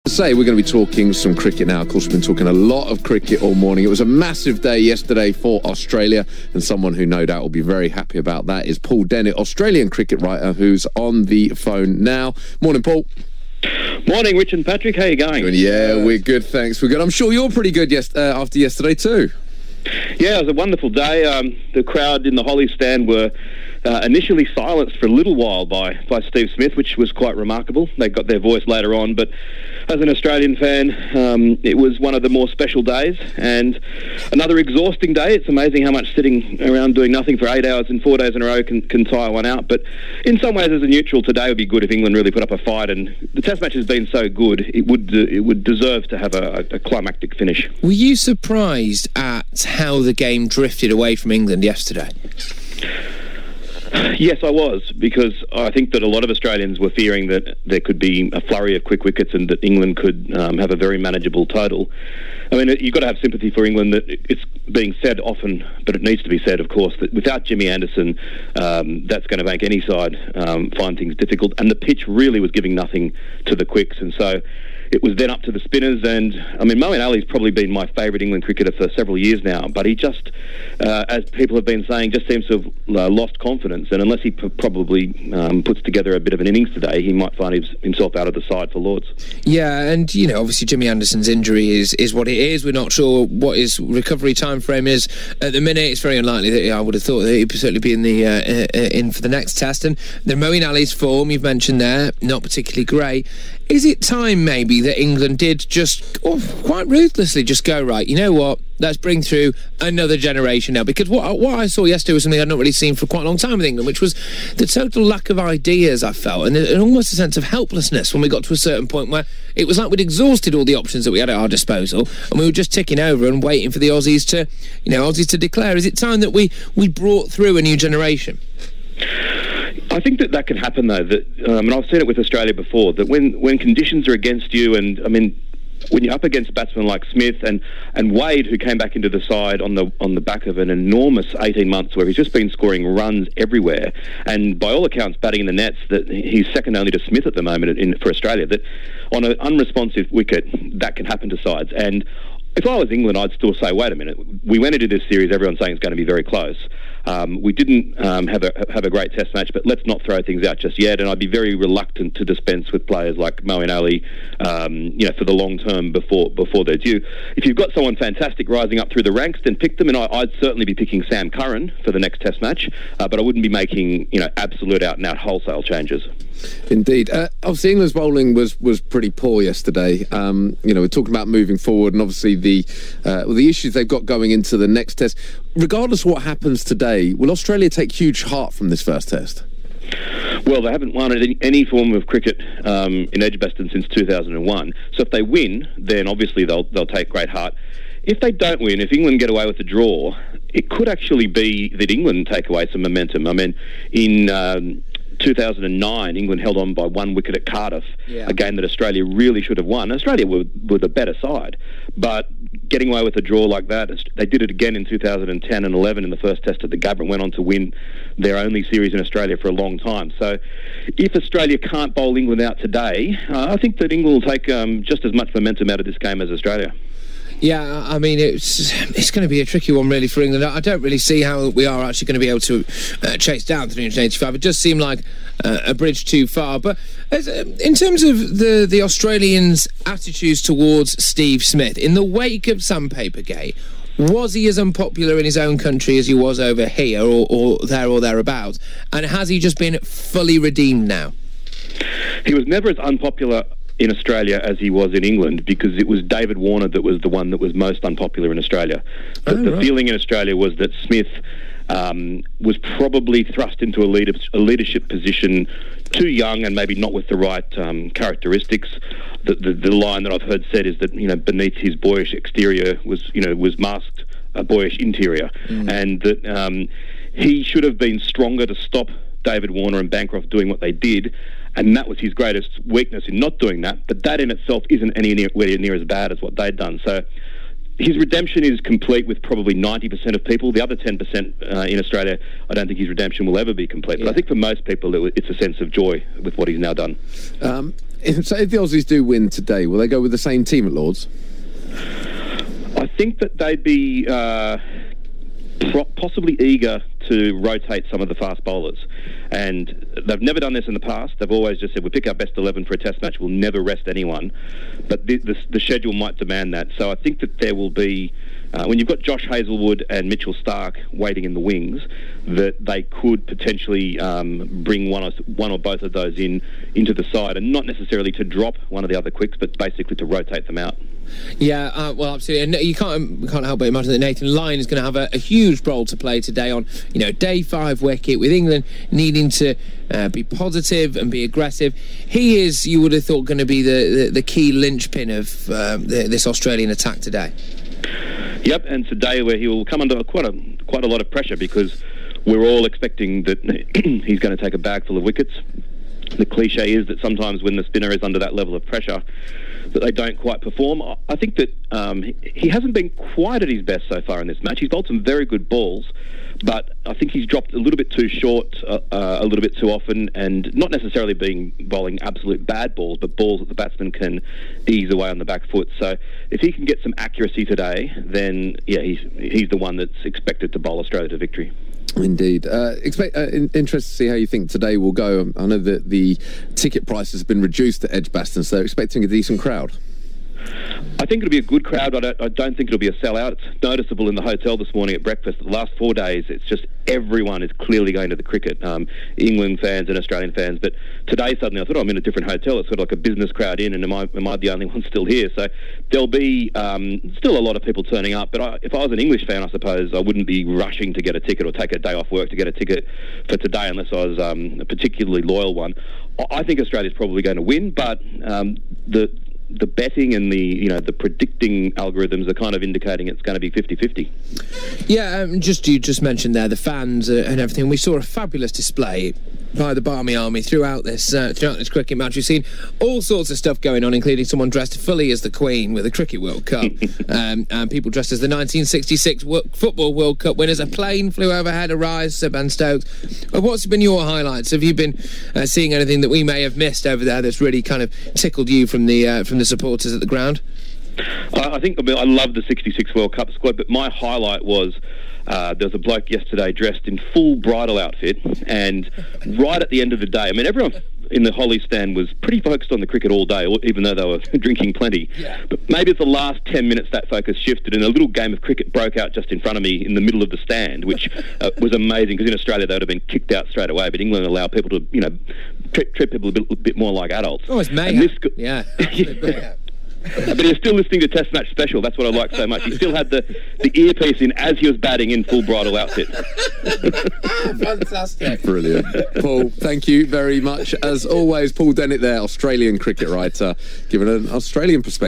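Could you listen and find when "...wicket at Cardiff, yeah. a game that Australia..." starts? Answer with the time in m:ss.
3:27.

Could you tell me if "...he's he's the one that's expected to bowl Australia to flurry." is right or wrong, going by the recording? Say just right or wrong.
wrong.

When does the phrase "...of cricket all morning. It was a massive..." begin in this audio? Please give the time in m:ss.
0:02.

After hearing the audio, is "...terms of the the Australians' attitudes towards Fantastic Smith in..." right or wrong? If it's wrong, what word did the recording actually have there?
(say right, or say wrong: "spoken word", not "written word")
wrong: "Steve", not "Fantastic".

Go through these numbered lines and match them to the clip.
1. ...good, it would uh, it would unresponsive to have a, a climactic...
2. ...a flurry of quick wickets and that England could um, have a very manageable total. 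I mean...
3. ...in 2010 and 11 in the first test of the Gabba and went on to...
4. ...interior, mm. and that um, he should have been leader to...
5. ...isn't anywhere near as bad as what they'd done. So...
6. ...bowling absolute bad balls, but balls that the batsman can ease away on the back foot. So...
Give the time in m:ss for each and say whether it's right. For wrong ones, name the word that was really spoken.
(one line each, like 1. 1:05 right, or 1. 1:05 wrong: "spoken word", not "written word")
1. 0:44 wrong: "deserve", not "unresponsive"
2. 0:58 right
3. 3:34 right
4. 4:34 wrong: "stronger", not "leader"
5. 4:44 right
6. 6:11 right.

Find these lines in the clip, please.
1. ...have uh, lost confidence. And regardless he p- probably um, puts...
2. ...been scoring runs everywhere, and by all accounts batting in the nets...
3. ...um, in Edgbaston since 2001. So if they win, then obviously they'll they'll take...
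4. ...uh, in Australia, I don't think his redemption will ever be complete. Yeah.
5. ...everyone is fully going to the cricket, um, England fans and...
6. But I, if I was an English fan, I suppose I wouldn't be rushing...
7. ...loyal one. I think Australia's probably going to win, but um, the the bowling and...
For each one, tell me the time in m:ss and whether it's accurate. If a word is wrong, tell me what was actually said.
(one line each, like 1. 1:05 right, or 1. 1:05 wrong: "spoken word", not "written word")
1. 1:22 wrong: "unless", not "regardless"
2. 2:22 right
3. 3:12 right
4. 4:51 right
5. 6:36 wrong: "clearly", not "fully"
6. 6:48 right
7. 6:55 wrong: "betting", not "bowling".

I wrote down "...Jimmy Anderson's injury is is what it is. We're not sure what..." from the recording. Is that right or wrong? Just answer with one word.
right.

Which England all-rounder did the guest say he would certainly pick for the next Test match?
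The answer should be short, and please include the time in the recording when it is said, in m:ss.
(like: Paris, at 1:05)
Sam Curran, at 2:51.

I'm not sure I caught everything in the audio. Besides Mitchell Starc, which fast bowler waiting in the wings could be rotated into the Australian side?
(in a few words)
Josh Hazlewood.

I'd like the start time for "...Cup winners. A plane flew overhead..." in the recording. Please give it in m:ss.
7:20.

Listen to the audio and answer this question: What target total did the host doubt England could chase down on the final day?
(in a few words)
385.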